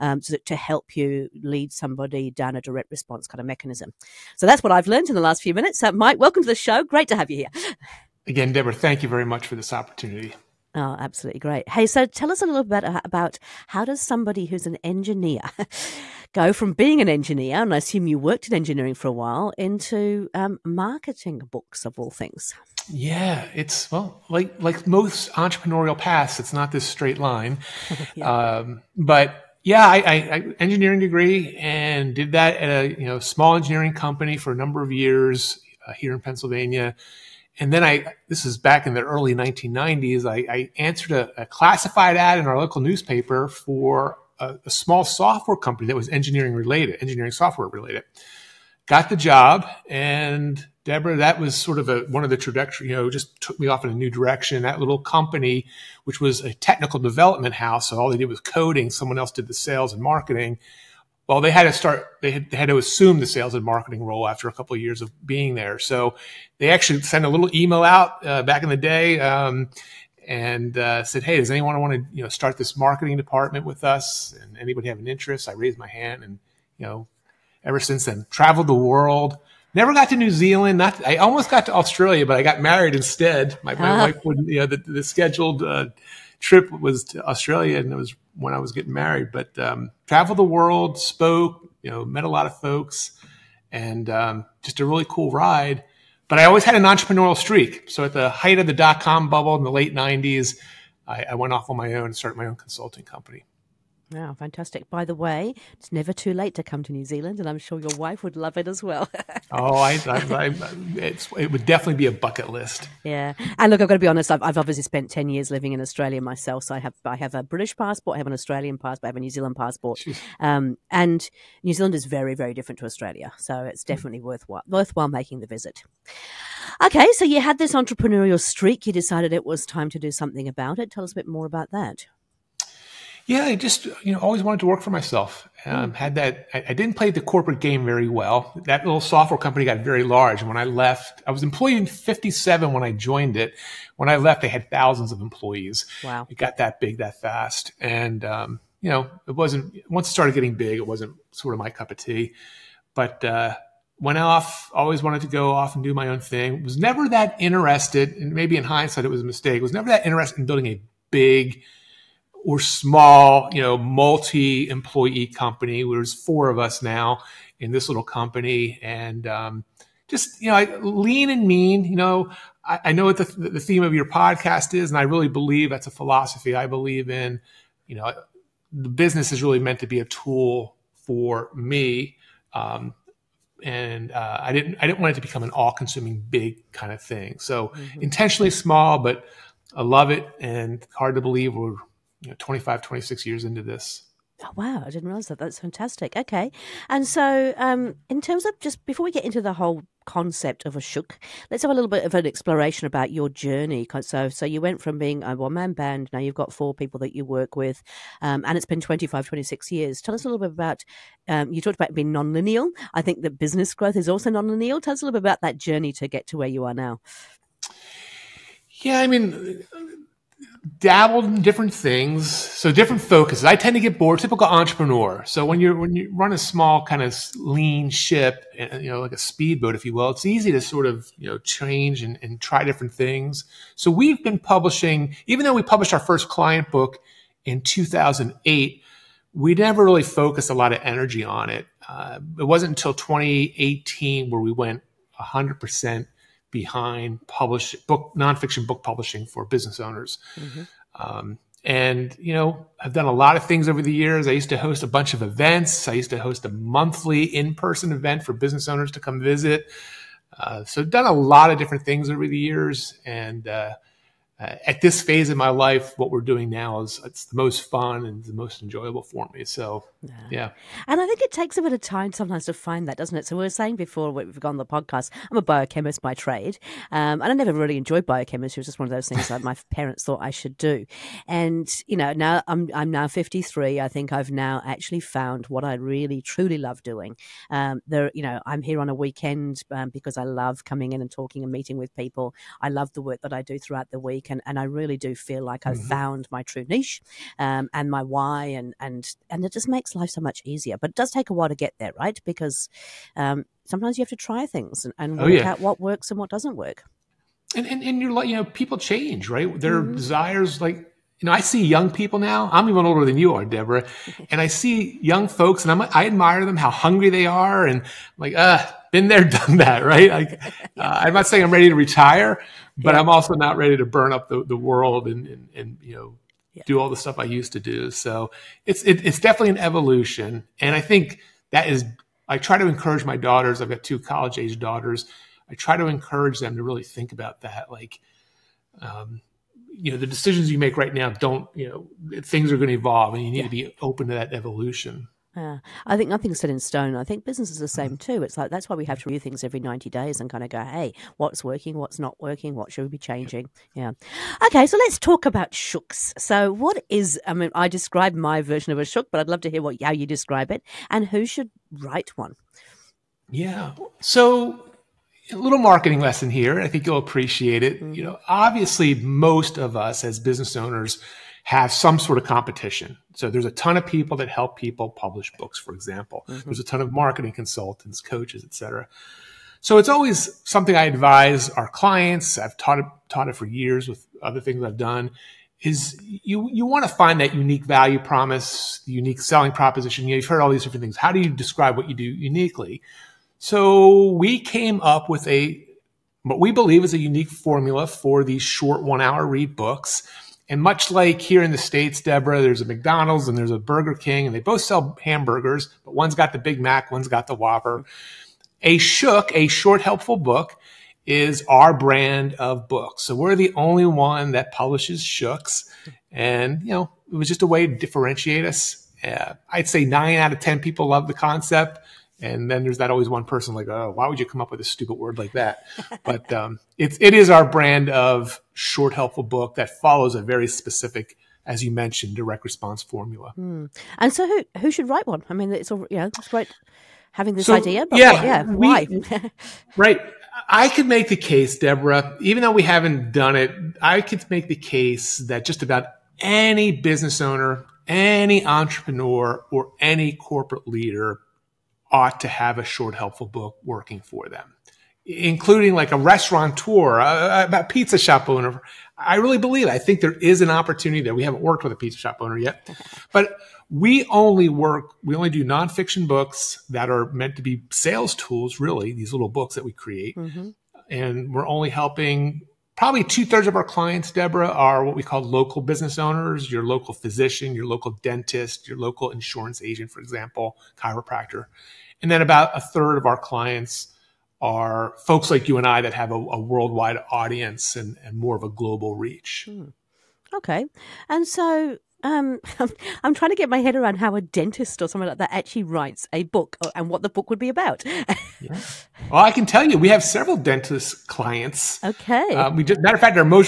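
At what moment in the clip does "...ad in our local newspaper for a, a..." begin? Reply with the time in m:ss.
0:42.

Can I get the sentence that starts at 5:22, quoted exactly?
I'm also not ready to burn up the, the world and, and, and you know, yeah.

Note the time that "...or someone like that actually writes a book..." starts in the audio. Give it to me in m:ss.
8:14.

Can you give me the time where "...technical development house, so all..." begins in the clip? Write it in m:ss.
0:56.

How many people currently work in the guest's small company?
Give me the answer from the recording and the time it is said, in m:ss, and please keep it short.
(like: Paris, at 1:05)
4, at 2:46.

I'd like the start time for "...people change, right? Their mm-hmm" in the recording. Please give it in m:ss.
5:08.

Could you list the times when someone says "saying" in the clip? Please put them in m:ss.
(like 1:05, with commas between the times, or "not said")
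4:33, 5:21.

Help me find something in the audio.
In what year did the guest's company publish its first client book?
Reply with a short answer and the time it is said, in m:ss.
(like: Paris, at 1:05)
2008, at 3:57.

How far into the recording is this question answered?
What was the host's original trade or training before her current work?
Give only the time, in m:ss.
4:35.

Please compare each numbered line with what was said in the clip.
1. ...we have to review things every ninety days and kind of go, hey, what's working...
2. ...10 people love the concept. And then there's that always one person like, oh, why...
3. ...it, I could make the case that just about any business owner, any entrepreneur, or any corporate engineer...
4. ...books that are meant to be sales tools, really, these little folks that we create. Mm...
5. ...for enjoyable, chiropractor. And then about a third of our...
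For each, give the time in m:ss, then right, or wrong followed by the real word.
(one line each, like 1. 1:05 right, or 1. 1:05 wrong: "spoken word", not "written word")
1. 5:48 right
2. 7:00 right
3. 7:23 wrong: "leader", not "engineer"
4. 7:46 wrong: "books", not "folks"
5. 7:59 wrong: "example", not "enjoyable".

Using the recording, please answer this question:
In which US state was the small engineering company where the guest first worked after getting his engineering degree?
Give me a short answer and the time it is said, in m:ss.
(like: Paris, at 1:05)
Pennsylvania, at 0:36.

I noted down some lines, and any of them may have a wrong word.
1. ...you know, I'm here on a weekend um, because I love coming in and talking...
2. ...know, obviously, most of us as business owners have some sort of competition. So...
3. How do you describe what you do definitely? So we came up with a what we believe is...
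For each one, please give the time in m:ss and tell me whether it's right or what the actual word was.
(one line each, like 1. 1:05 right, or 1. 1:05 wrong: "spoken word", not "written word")
1. 4:48 right
2. 6:08 right
3. 6:30 wrong: "uniquely", not "definitely".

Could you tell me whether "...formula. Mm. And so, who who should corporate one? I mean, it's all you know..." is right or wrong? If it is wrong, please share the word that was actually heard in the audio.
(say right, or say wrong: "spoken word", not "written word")
wrong: "write", not "corporate".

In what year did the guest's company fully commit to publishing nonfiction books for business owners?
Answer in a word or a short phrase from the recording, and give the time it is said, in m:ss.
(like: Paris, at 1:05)
2018, at 4:02.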